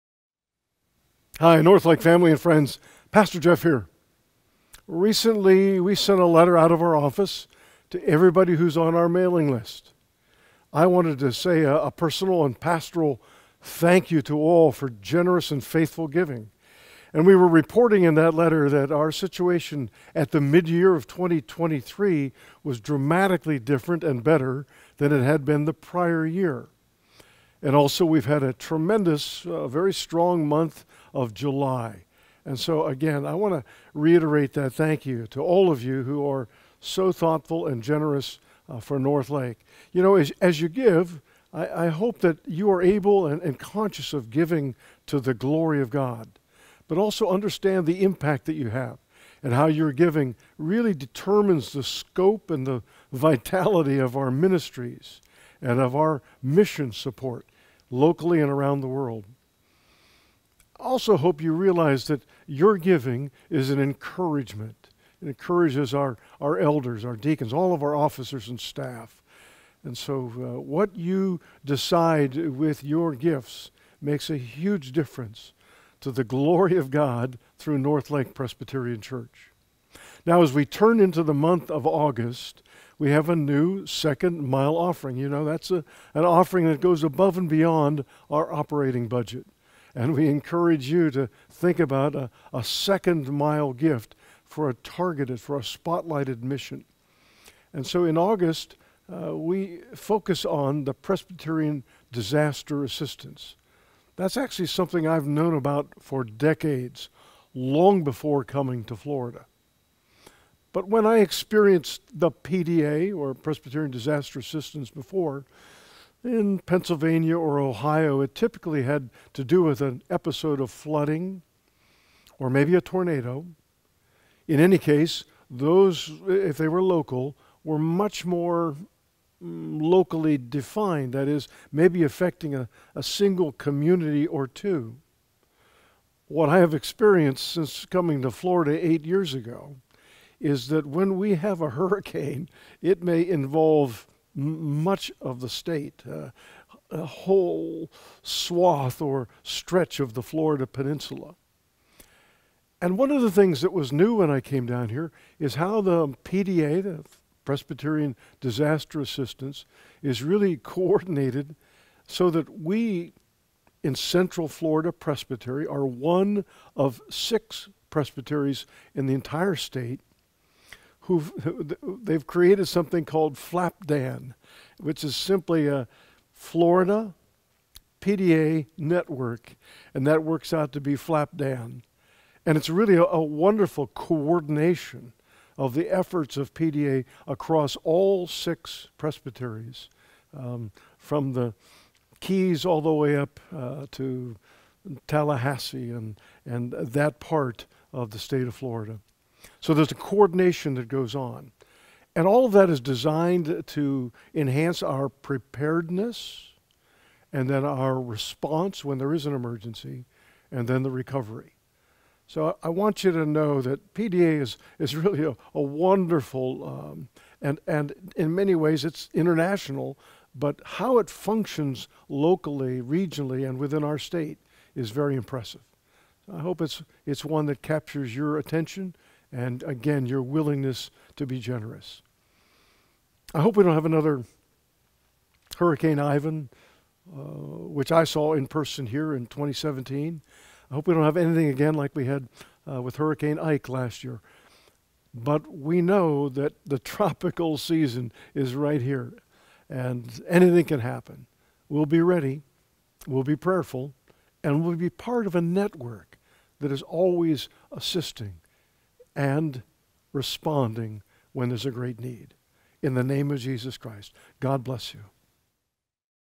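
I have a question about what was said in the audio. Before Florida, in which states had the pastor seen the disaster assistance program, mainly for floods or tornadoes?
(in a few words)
Pennsylvania or Ohio.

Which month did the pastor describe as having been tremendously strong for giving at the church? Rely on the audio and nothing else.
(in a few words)
July.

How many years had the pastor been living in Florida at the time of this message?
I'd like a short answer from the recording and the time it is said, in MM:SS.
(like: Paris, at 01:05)
8, at 02:18.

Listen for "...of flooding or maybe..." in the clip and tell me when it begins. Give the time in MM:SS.
02:00.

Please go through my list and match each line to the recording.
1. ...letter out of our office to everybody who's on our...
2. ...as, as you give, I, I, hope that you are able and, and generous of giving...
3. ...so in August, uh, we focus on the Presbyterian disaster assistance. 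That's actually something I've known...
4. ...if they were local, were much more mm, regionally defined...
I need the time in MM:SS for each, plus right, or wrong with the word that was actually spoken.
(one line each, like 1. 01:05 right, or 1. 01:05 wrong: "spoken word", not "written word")
1. 00:06 right
2. 00:40 wrong: "conscious", not "generous"
3. 01:37 right
4. 02:06 wrong: "locally", not "regionally".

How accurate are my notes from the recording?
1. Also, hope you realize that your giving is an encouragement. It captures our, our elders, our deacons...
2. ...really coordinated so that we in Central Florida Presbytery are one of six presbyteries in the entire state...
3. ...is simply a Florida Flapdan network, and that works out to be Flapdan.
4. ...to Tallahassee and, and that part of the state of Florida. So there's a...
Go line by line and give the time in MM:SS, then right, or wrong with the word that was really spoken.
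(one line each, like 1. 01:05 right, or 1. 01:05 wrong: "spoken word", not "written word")
1. 01:00 wrong: "encourages", not "captures"
2. 02:40 right
3. 02:55 wrong: "PDA", not "Flapdan"
4. 03:13 right.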